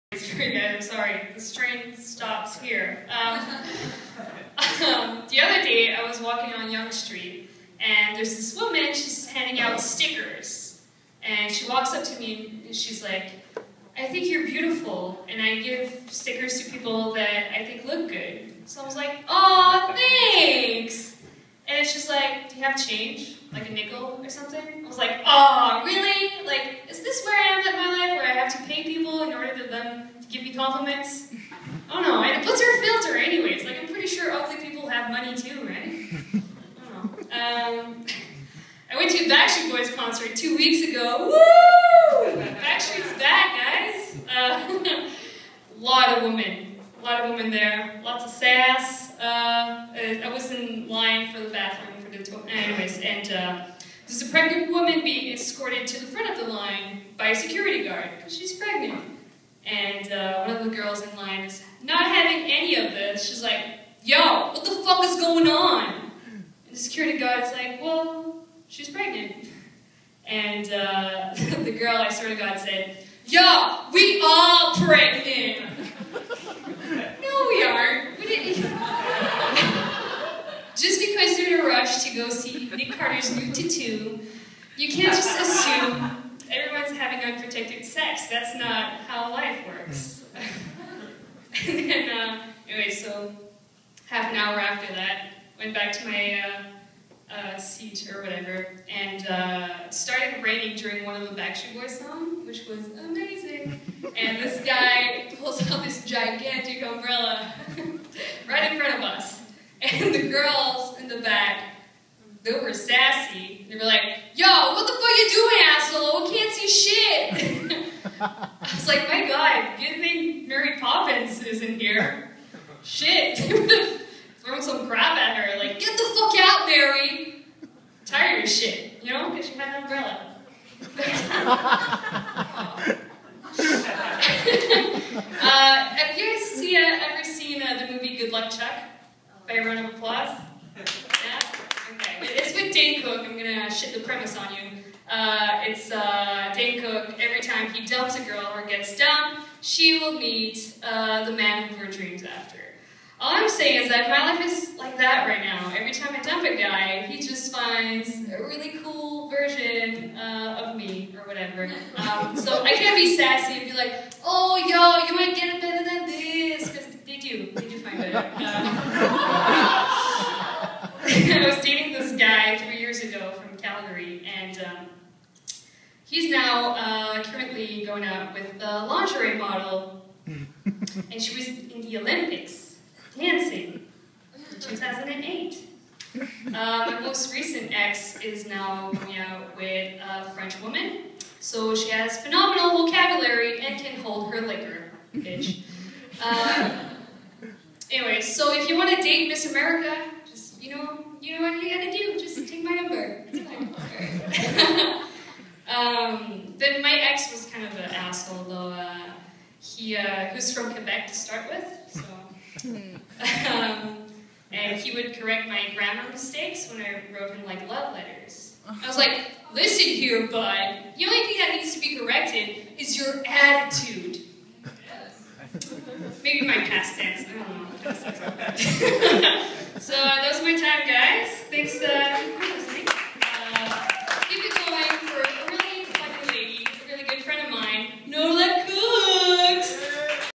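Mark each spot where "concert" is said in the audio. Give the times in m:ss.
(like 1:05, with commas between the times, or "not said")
0:39.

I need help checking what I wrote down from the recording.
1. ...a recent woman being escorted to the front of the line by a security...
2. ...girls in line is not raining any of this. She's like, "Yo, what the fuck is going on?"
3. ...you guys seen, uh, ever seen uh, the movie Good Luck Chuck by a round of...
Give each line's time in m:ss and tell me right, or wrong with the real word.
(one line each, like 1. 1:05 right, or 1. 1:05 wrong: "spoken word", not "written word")
1. 0:54 wrong: "pregnant", not "recent"
2. 1:00 wrong: "having", not "raining"
3. 2:16 right.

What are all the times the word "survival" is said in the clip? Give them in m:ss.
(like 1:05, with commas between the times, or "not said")
not said.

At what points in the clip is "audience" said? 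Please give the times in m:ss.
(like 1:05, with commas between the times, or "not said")
not said.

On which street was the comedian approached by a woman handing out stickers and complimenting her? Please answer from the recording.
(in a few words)
Yonge Street.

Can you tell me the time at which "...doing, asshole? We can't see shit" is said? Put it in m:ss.
1:55.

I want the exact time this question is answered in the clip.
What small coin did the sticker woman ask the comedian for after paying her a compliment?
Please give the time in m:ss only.
0:23.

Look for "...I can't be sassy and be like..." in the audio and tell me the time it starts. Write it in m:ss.
2:42.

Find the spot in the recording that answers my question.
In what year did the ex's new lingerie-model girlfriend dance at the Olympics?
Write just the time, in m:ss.
3:04.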